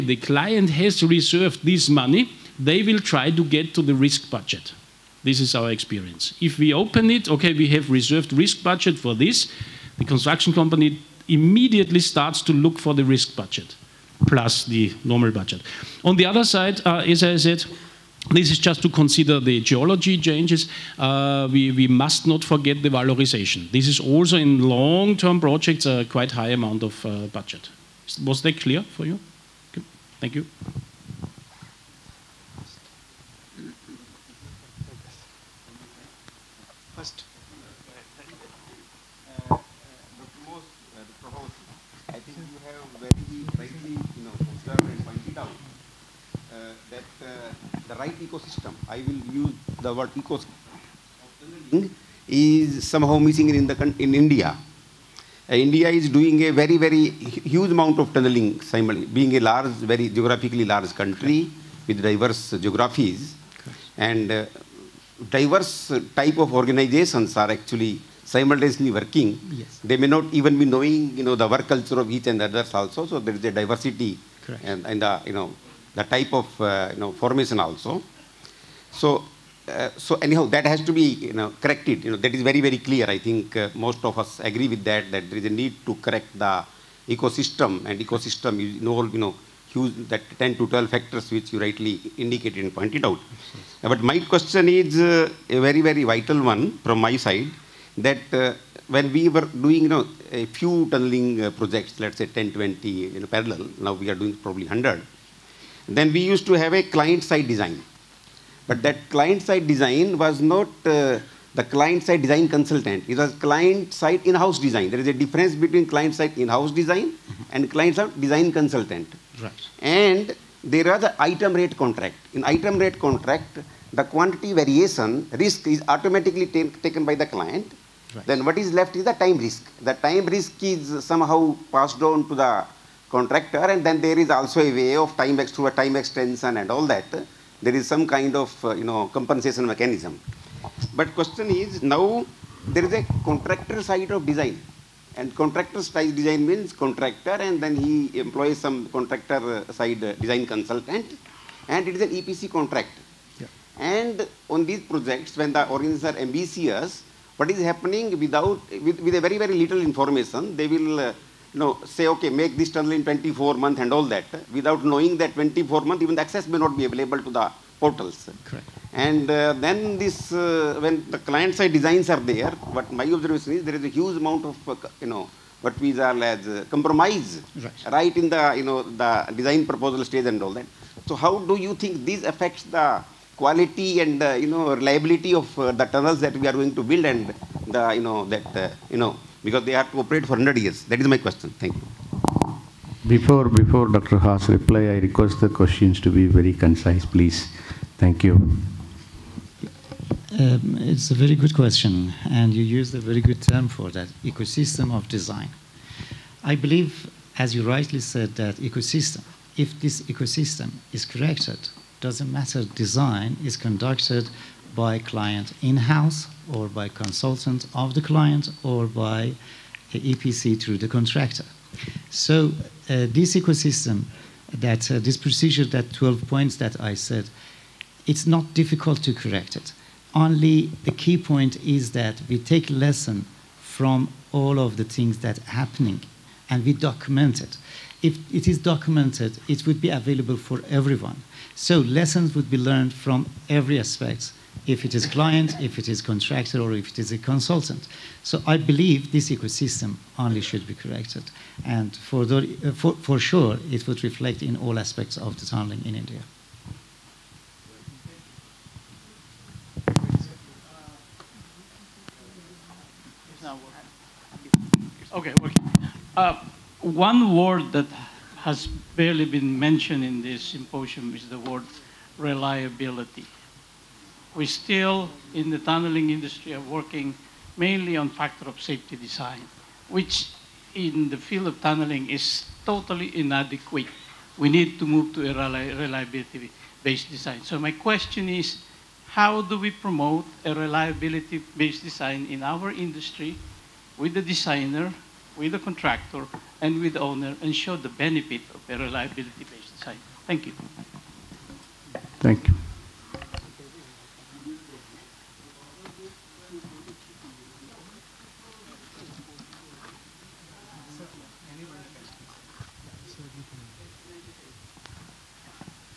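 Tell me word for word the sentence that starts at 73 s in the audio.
So there is a diversity and, and the, you know, the type of uh, you know, formation also.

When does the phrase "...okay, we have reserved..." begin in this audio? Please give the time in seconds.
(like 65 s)
7 s.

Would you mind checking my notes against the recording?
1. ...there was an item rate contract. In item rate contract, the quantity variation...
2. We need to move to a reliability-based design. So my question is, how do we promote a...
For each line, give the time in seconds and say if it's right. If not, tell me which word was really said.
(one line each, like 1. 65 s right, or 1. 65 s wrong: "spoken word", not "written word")
1. 120 s right
2. 284 s right.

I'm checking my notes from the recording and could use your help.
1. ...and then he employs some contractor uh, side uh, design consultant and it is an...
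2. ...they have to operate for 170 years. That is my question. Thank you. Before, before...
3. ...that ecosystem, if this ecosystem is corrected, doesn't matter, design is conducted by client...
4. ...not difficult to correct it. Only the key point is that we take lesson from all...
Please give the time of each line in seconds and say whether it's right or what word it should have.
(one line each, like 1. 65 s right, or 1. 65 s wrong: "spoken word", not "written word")
1. 147 s right
2. 189 s wrong: "100", not "170"
3. 208 s right
4. 228 s right.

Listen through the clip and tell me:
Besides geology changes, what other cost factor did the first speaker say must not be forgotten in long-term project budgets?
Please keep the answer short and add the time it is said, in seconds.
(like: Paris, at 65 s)
valorization, at 22 s.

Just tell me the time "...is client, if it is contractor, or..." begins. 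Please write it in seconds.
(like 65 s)
244 s.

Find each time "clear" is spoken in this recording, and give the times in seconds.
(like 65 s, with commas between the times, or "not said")
28 s, 82 s.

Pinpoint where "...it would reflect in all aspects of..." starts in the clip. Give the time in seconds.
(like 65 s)
253 s.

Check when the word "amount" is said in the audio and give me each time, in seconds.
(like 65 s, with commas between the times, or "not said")
26 s, 57 s, 174 s.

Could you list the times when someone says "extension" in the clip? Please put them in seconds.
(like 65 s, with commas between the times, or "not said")
136 s.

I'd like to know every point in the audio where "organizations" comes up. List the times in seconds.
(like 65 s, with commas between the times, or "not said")
66 s, 155 s.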